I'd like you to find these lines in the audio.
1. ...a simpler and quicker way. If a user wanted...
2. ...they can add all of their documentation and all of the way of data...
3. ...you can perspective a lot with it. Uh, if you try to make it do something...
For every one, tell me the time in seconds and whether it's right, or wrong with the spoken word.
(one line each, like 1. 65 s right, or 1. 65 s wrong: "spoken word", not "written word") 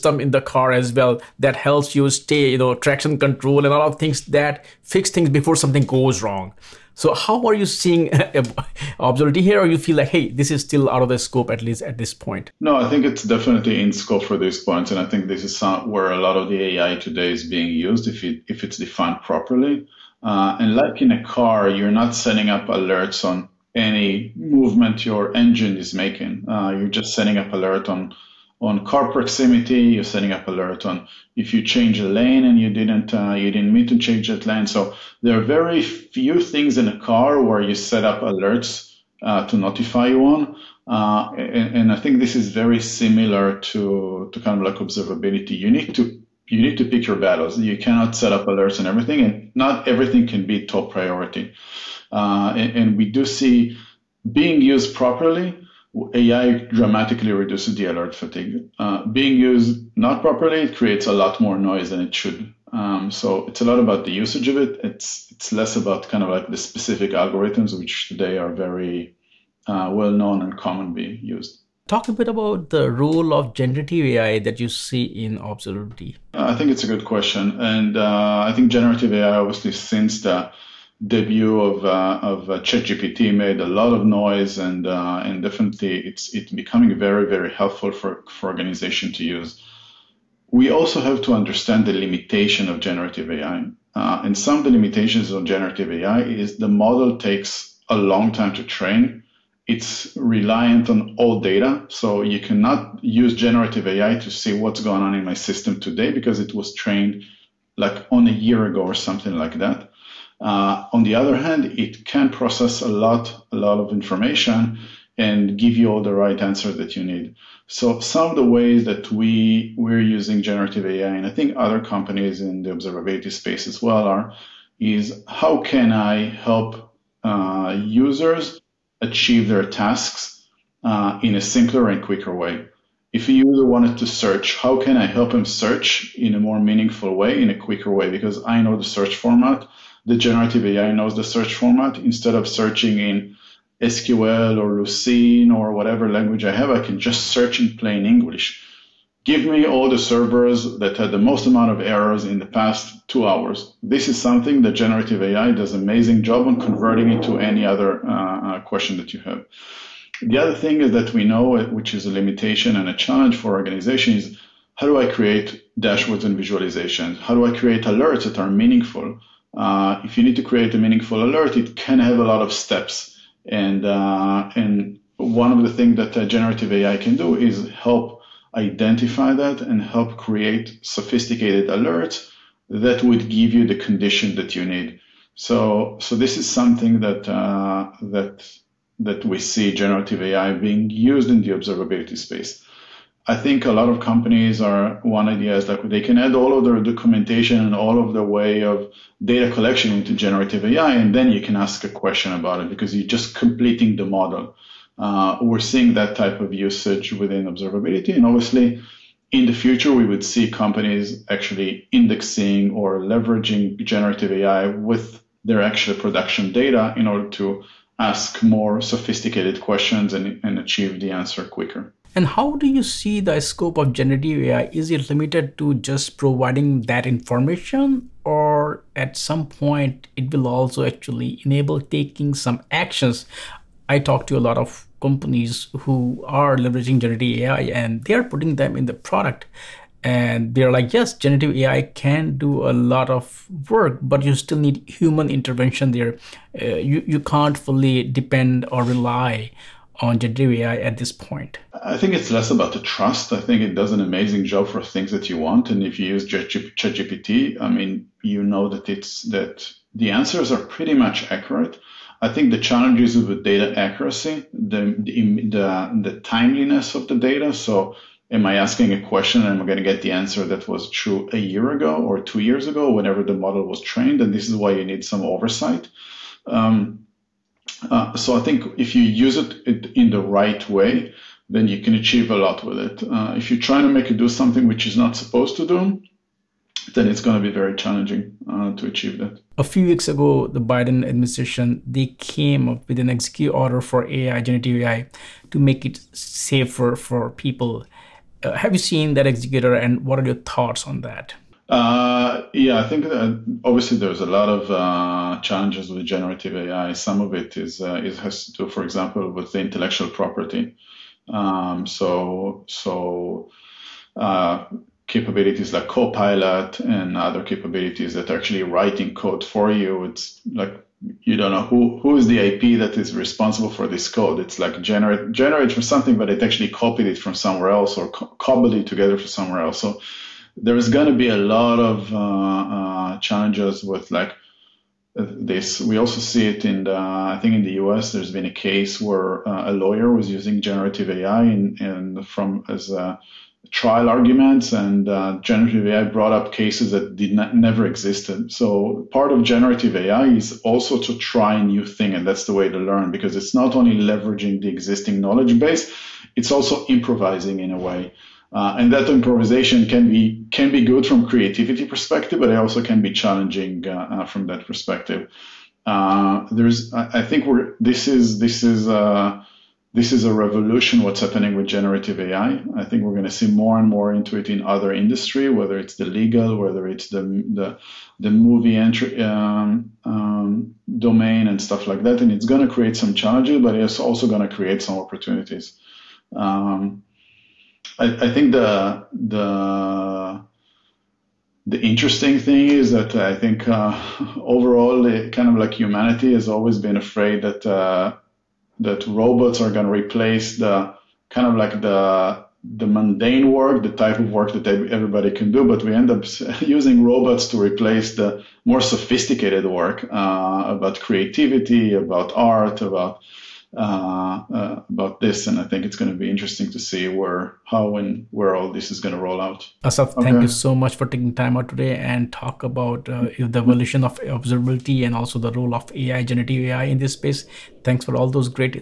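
1. 131 s right
2. 195 s right
3. 281 s wrong: "achieve", not "perspective".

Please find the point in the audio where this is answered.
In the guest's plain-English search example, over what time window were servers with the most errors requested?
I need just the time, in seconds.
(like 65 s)
152 s.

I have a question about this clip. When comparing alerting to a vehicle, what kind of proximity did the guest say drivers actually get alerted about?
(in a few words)
car proximity.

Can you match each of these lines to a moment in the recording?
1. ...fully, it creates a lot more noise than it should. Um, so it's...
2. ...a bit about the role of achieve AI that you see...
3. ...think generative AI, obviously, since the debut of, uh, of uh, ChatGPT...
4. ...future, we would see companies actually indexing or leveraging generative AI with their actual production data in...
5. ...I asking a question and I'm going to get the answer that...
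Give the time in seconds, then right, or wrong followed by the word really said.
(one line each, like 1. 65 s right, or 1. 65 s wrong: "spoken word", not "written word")
1. 60 s wrong: "properly", not "fully"
2. 72 s wrong: "generative", not "achieve"
3. 78 s right
4. 209 s right
5. 268 s right.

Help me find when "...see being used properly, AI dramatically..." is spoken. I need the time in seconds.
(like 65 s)
53 s.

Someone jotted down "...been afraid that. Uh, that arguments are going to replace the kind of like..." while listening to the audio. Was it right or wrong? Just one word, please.
wrong.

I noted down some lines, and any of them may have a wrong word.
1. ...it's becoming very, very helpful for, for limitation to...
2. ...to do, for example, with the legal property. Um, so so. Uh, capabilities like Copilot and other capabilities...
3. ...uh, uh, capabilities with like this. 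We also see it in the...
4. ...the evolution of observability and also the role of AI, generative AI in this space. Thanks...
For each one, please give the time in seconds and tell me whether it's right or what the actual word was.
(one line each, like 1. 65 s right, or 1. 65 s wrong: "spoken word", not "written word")
1. 86 s wrong: "organization", not "limitation"
2. 308 s wrong: "intellectual", not "legal"
3. 332 s wrong: "challenges", not "capabilities"
4. 423 s right.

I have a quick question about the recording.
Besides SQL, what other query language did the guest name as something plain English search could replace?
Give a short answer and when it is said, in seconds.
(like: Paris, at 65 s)
Lucene, at 144 s.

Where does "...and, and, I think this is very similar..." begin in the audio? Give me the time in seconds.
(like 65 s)
41 s.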